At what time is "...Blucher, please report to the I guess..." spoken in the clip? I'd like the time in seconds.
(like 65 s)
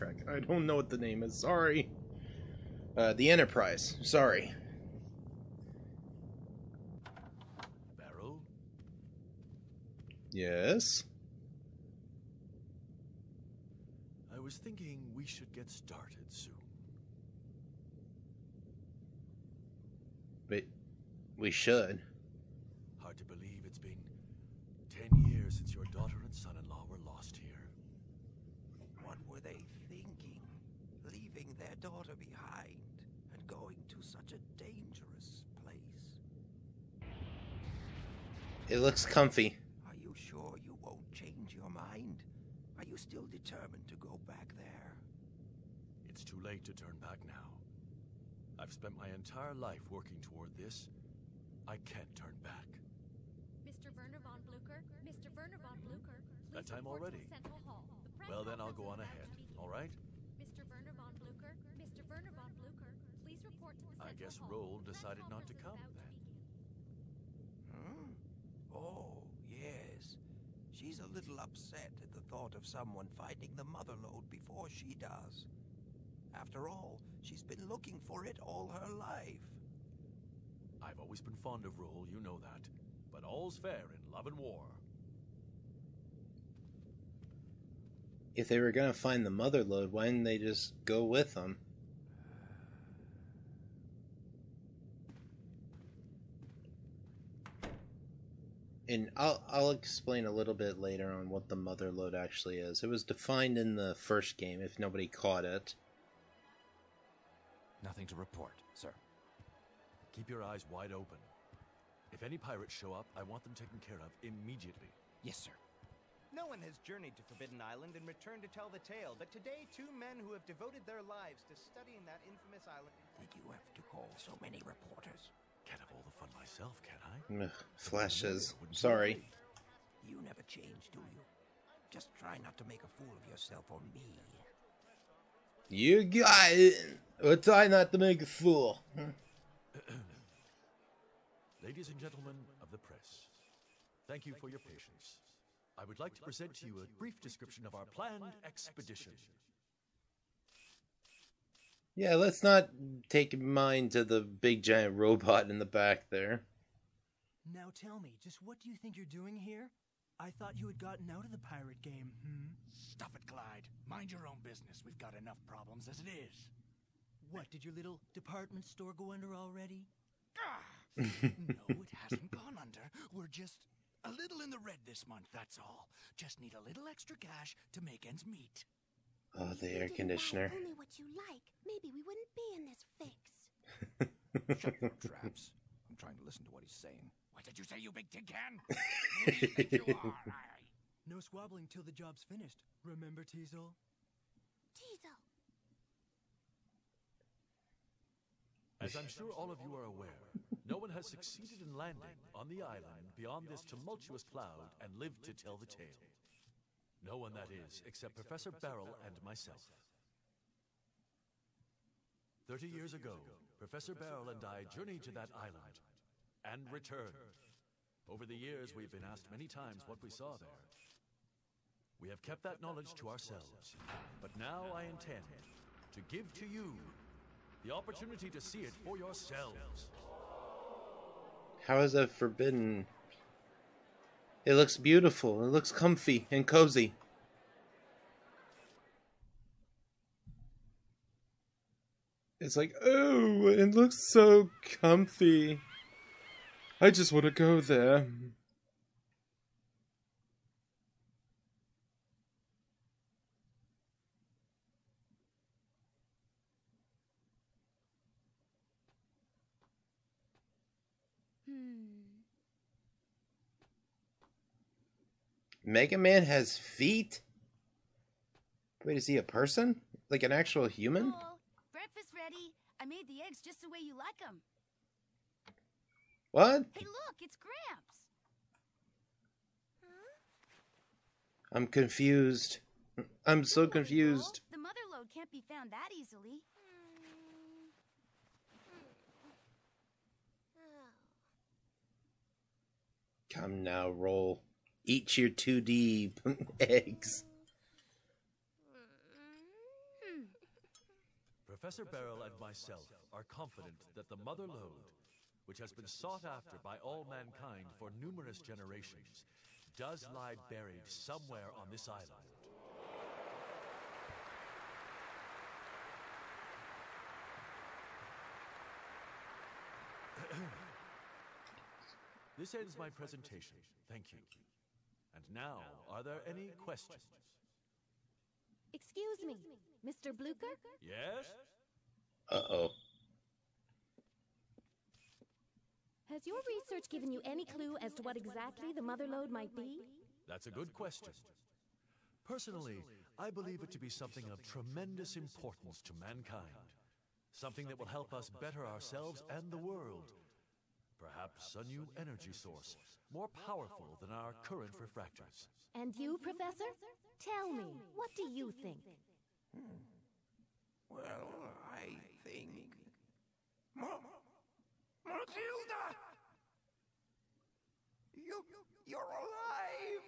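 62 s.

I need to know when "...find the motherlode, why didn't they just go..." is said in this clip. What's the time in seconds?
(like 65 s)
88 s.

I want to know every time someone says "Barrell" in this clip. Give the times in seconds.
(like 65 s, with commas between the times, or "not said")
208 s, 213 s, 301 s.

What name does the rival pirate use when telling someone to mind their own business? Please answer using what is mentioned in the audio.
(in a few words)
Glyde.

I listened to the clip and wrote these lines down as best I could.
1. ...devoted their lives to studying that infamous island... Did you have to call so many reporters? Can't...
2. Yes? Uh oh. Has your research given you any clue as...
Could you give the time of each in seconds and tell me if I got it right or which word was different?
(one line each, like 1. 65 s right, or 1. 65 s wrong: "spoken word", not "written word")
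1. 120 s right
2. 330 s right.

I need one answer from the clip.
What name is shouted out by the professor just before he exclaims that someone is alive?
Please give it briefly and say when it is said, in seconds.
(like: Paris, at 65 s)
Matilda, at 365 s.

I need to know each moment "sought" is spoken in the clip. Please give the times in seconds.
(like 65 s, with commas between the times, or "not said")
305 s.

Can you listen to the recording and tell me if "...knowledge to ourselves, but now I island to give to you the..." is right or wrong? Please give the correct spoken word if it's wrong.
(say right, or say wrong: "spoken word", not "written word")
wrong: "intend", not "island".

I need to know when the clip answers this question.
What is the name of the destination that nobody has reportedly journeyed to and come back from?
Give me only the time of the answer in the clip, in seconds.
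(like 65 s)
117 s.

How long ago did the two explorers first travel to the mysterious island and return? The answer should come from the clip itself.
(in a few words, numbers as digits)
30 years.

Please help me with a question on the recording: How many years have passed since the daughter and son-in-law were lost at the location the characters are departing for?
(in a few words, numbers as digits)
10.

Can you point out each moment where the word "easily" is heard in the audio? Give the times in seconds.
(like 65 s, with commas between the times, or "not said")
285 s.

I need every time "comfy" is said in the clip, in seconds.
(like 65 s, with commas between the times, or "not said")
39 s, 235 s, 244 s.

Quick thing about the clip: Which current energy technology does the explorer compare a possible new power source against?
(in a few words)
refractors.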